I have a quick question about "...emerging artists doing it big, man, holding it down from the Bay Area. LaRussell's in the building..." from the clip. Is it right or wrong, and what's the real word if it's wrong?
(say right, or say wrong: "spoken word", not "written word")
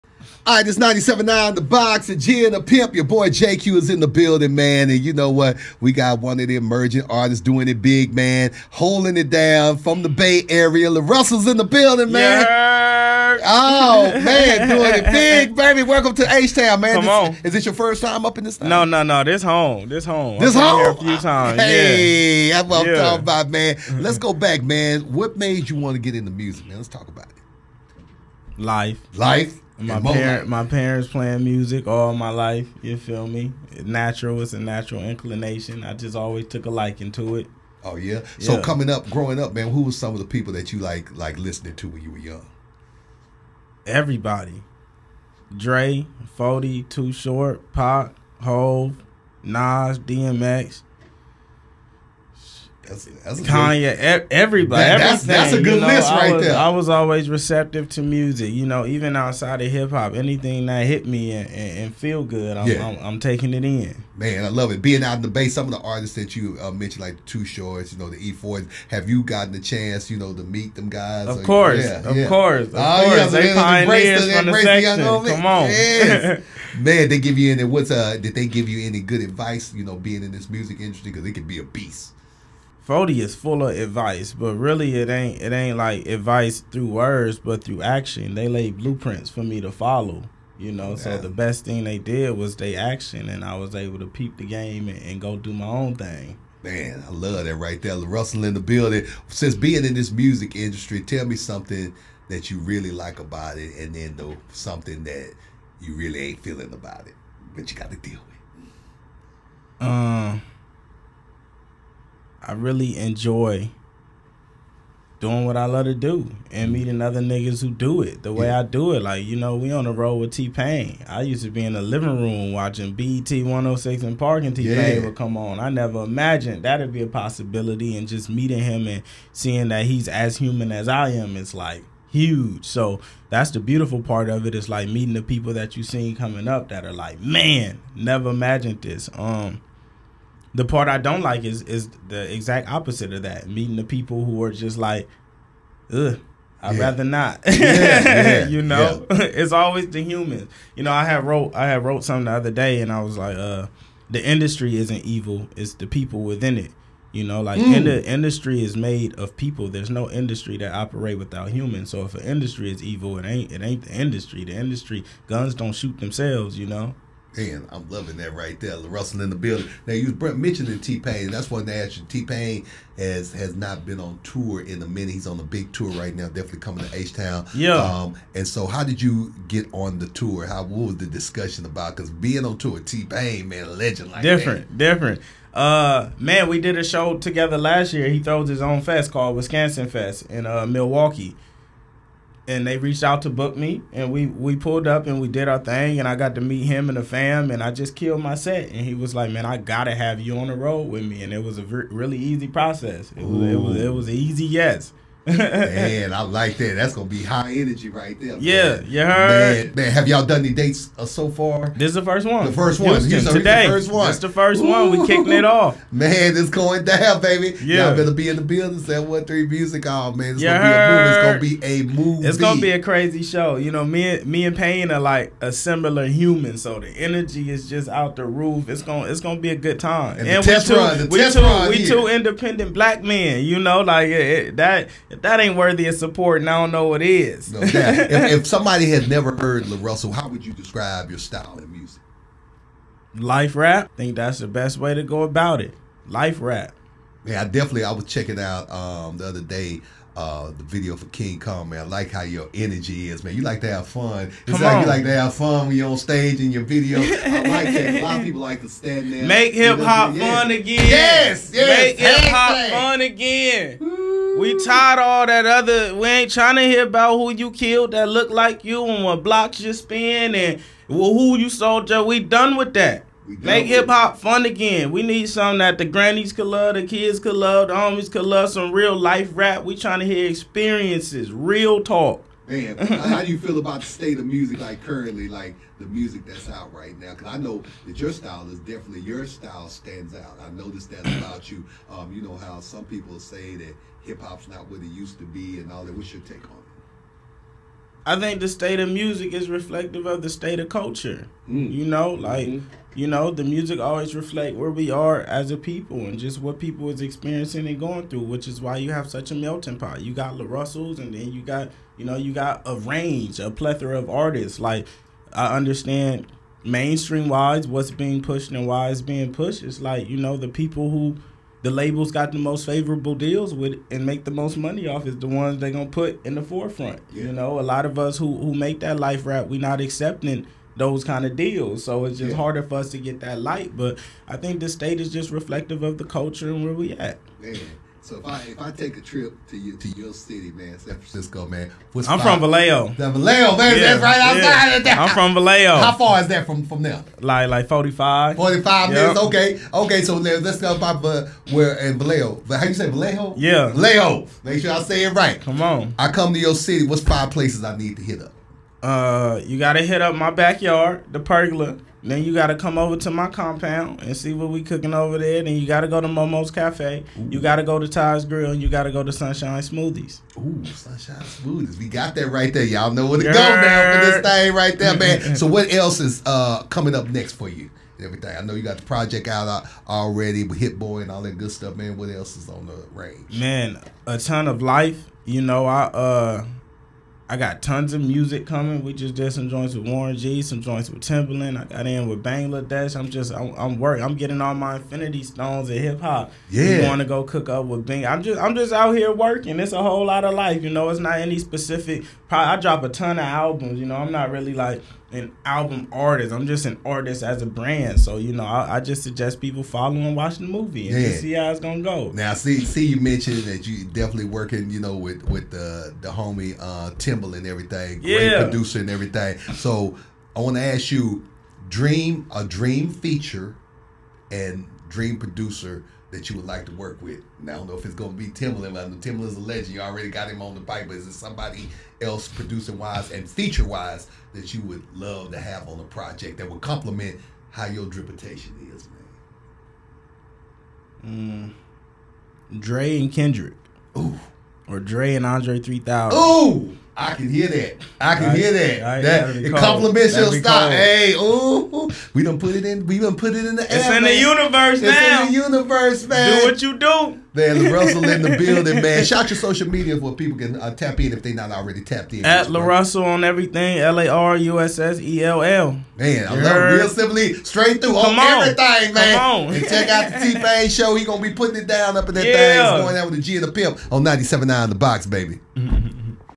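right.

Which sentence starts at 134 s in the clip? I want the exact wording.
It's like meeting the people that you seen coming up that are like, Man, never imagined this.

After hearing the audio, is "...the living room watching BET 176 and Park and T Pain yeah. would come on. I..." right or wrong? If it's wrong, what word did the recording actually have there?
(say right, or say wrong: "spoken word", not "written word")
wrong: "106", not "176".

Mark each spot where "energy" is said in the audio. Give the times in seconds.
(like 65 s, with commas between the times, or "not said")
207 s, 226 s, 252 s.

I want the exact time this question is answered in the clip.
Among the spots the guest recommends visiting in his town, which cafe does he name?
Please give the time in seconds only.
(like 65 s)
366 s.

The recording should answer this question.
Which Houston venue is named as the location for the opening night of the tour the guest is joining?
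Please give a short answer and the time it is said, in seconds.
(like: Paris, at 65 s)
713 Music Hall, at 218 s.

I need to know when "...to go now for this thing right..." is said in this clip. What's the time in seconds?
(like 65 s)
373 s.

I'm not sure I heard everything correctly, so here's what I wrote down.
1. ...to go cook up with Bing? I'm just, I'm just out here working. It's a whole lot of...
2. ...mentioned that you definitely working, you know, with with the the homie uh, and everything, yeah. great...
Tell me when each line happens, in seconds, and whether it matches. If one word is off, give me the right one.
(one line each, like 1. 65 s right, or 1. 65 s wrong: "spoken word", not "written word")
1. 396 s right
2. 412 s right.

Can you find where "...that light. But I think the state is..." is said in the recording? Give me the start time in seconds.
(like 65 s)
333 s.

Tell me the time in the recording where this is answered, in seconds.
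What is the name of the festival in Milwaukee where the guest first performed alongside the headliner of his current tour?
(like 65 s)
189 s.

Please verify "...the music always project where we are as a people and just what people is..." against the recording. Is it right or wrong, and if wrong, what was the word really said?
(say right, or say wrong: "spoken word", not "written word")
wrong: "reflect", not "project".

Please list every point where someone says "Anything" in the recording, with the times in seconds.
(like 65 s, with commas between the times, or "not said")
60 s.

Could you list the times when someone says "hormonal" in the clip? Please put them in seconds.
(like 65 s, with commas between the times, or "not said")
not said.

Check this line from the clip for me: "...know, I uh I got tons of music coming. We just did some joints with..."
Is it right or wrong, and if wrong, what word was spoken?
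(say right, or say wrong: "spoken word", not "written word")
right.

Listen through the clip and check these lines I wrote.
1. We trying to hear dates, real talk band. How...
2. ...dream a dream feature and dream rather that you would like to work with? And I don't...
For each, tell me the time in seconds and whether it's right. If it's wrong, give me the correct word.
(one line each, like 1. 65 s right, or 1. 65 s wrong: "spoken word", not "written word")
1. 279 s wrong: "experiences", not "dates"
2. 421 s wrong: "producer", not "rather".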